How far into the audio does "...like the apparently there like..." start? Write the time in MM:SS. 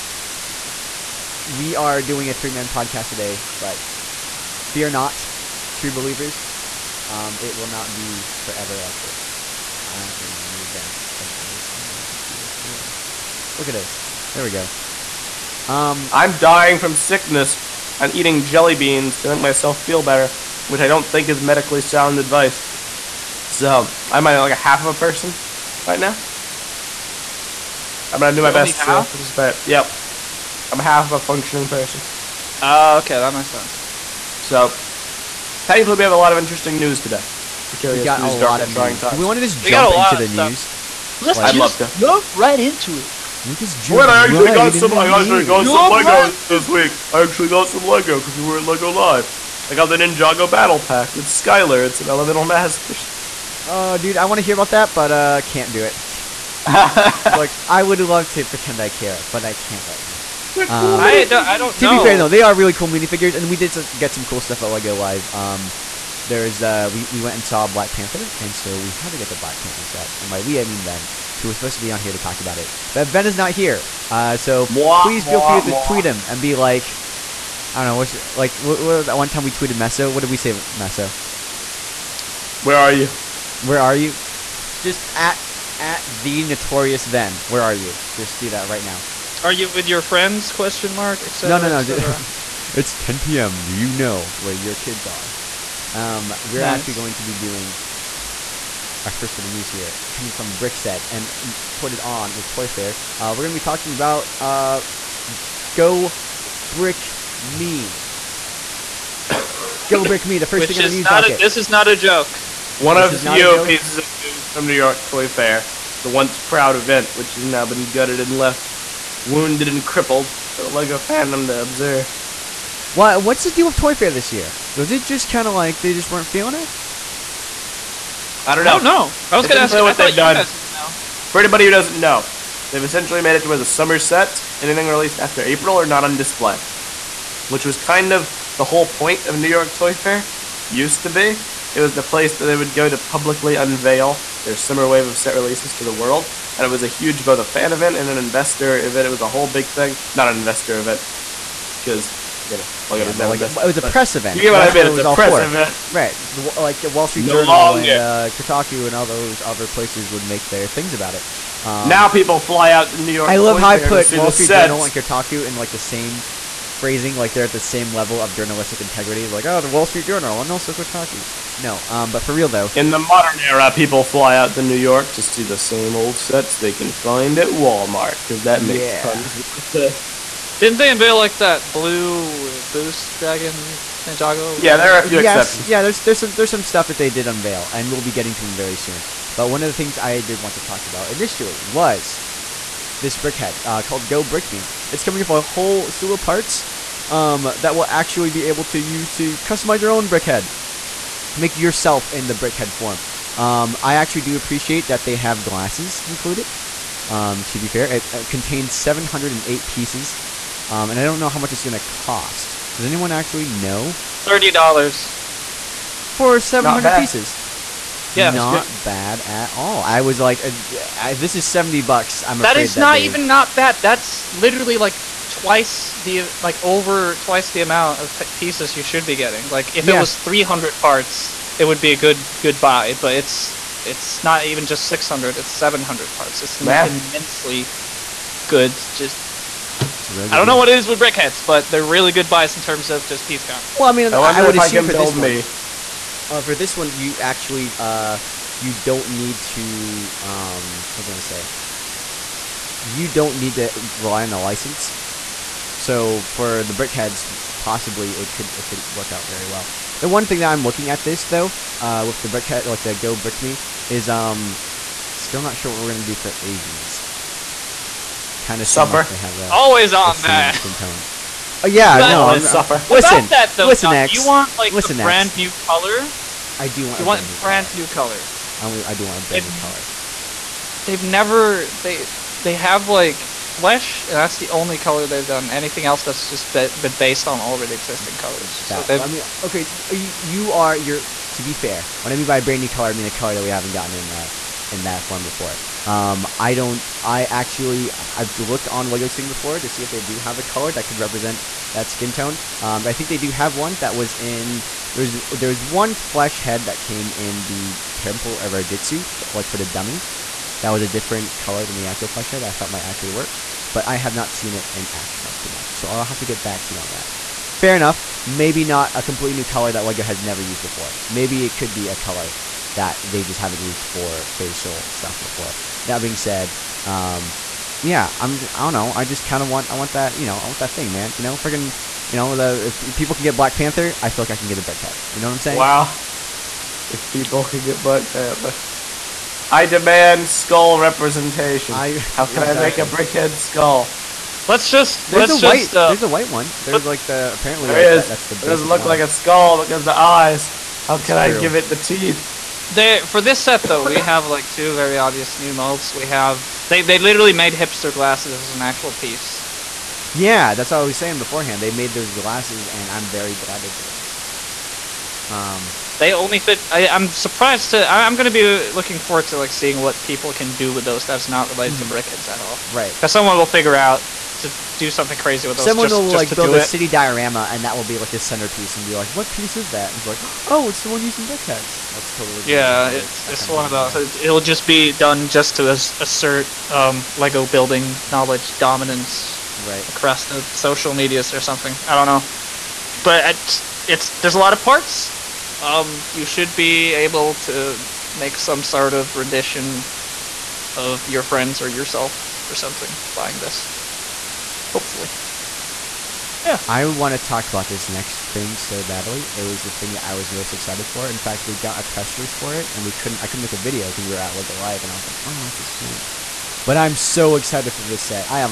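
05:46.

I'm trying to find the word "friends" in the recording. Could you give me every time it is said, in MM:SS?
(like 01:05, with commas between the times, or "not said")
01:30, 06:41.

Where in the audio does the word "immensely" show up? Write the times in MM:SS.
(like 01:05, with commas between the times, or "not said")
03:56.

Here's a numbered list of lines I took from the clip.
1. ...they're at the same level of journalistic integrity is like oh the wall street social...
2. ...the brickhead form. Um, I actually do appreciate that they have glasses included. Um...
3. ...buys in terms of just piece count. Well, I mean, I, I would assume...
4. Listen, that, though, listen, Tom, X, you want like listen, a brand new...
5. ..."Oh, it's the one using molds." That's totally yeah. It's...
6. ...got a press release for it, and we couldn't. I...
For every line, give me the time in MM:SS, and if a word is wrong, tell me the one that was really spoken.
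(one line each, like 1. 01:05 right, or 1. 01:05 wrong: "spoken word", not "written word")
1. 02:47 wrong: "journal", not "social"
2. 03:22 right
3. 04:02 right
4. 04:32 right
5. 06:20 wrong: "brickheads", not "molds"
6. 06:51 right.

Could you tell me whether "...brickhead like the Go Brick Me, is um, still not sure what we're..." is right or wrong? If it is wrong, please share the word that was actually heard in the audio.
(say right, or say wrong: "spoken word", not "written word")
right.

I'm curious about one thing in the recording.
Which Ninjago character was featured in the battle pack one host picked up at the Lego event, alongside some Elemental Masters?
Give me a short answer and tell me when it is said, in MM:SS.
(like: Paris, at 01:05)
Skylor, at 00:51.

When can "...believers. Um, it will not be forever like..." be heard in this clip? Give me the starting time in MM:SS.
00:05.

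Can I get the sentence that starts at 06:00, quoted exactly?
Yeah, that's what I was saying beforehand.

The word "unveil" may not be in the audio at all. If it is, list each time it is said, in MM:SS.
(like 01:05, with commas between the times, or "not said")
02:23, 03:00, 03:07.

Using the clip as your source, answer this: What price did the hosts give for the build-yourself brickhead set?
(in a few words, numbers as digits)
$30.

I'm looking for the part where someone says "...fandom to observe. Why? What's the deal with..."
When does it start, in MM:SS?
02:00.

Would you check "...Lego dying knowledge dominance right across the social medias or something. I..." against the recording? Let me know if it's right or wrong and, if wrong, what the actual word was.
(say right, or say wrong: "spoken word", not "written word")
wrong: "building", not "dying".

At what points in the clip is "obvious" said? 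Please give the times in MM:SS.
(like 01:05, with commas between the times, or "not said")
05:54.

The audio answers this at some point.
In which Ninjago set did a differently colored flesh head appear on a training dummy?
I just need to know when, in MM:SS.
05:07.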